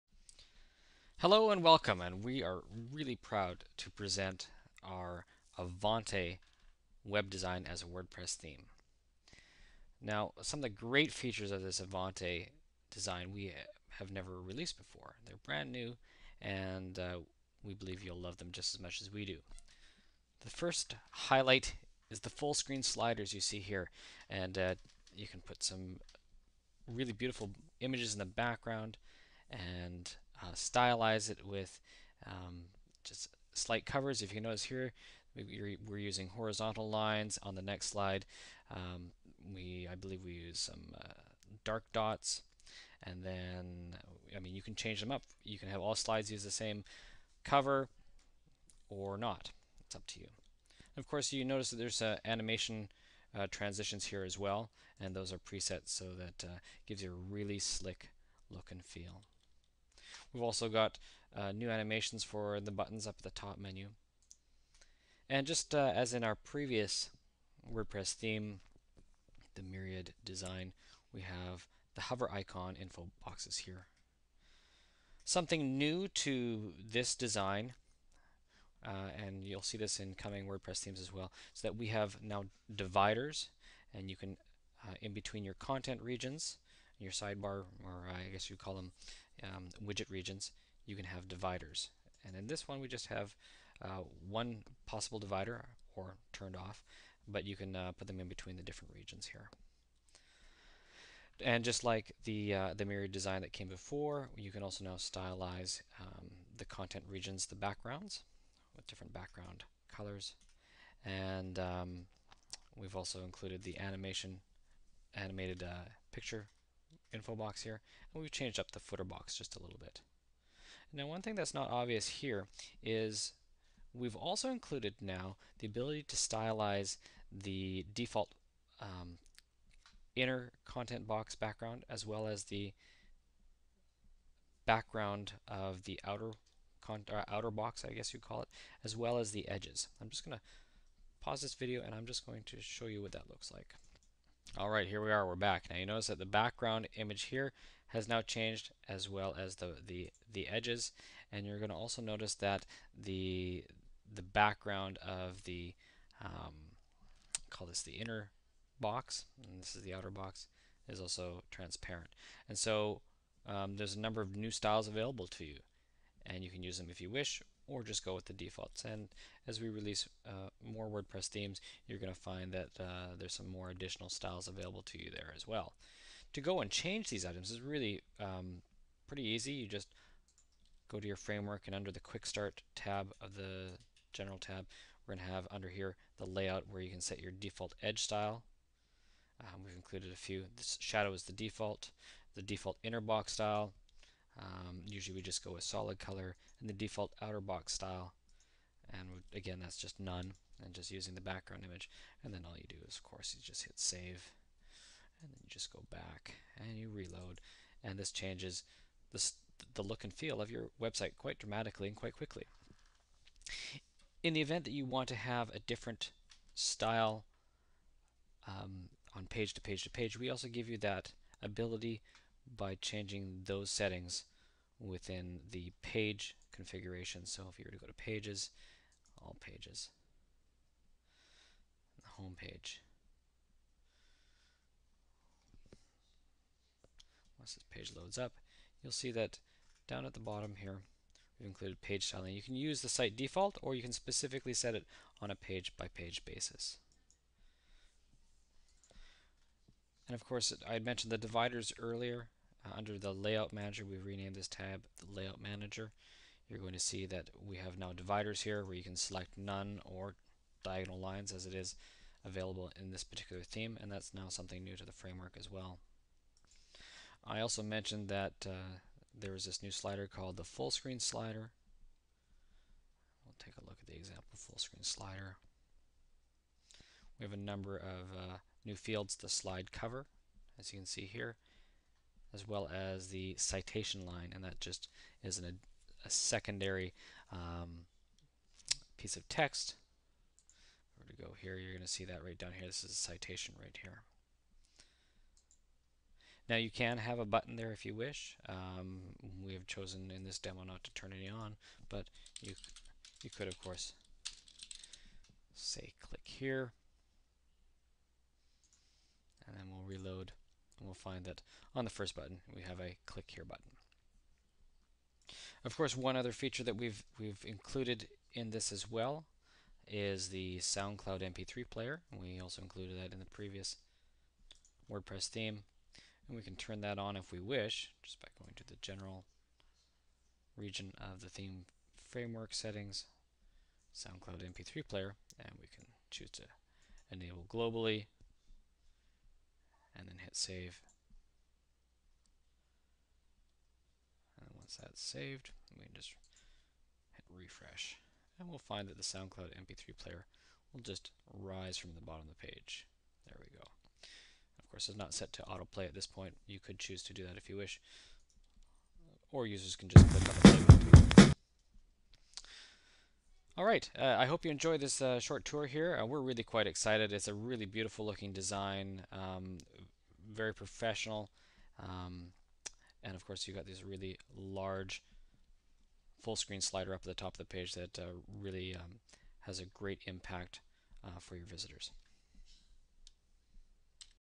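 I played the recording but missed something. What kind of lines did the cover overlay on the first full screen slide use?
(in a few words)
Horizontal lines.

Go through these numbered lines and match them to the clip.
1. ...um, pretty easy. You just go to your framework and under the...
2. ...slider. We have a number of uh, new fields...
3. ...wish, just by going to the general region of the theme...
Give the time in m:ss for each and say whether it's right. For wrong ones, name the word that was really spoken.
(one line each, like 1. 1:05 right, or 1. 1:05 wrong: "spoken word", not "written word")
1. 2:58 right
2. 4:34 right
3. 5:27 right.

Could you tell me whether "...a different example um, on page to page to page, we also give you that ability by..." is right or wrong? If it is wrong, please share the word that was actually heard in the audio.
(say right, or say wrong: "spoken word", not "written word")
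wrong: "style", not "example".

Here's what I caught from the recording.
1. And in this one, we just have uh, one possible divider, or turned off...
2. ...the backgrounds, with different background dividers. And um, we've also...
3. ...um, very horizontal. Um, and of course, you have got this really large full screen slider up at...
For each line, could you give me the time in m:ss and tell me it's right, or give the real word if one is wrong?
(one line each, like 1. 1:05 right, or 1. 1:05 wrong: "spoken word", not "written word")
1. 1:32 right
2. 1:47 wrong: "colors", not "dividers"
3. 6:09 wrong: "professional", not "horizontal".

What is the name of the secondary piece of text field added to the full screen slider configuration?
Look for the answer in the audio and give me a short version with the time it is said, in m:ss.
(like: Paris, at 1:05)
Citation line, at 4:43.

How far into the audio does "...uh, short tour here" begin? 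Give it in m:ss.
6:05.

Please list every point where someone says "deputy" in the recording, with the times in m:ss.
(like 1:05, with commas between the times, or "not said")
not said.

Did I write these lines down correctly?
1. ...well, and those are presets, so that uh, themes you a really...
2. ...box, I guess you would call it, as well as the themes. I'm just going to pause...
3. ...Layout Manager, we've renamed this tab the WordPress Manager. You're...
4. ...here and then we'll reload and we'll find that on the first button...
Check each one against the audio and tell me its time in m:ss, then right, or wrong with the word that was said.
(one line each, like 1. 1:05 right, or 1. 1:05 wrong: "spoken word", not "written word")
1. 0:54 wrong: "gives", not "themes"
2. 2:17 wrong: "edges", not "themes"
3. 4:13 wrong: "Layout", not "WordPress"
4. 5:06 right.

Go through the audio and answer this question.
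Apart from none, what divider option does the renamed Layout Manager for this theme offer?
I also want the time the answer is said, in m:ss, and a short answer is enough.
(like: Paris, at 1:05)
Diagonal lines, at 4:20.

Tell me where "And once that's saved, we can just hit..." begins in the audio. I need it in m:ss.
5:44.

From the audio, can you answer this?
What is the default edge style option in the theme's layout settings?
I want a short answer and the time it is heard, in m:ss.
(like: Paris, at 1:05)
Shadow, at 3:10.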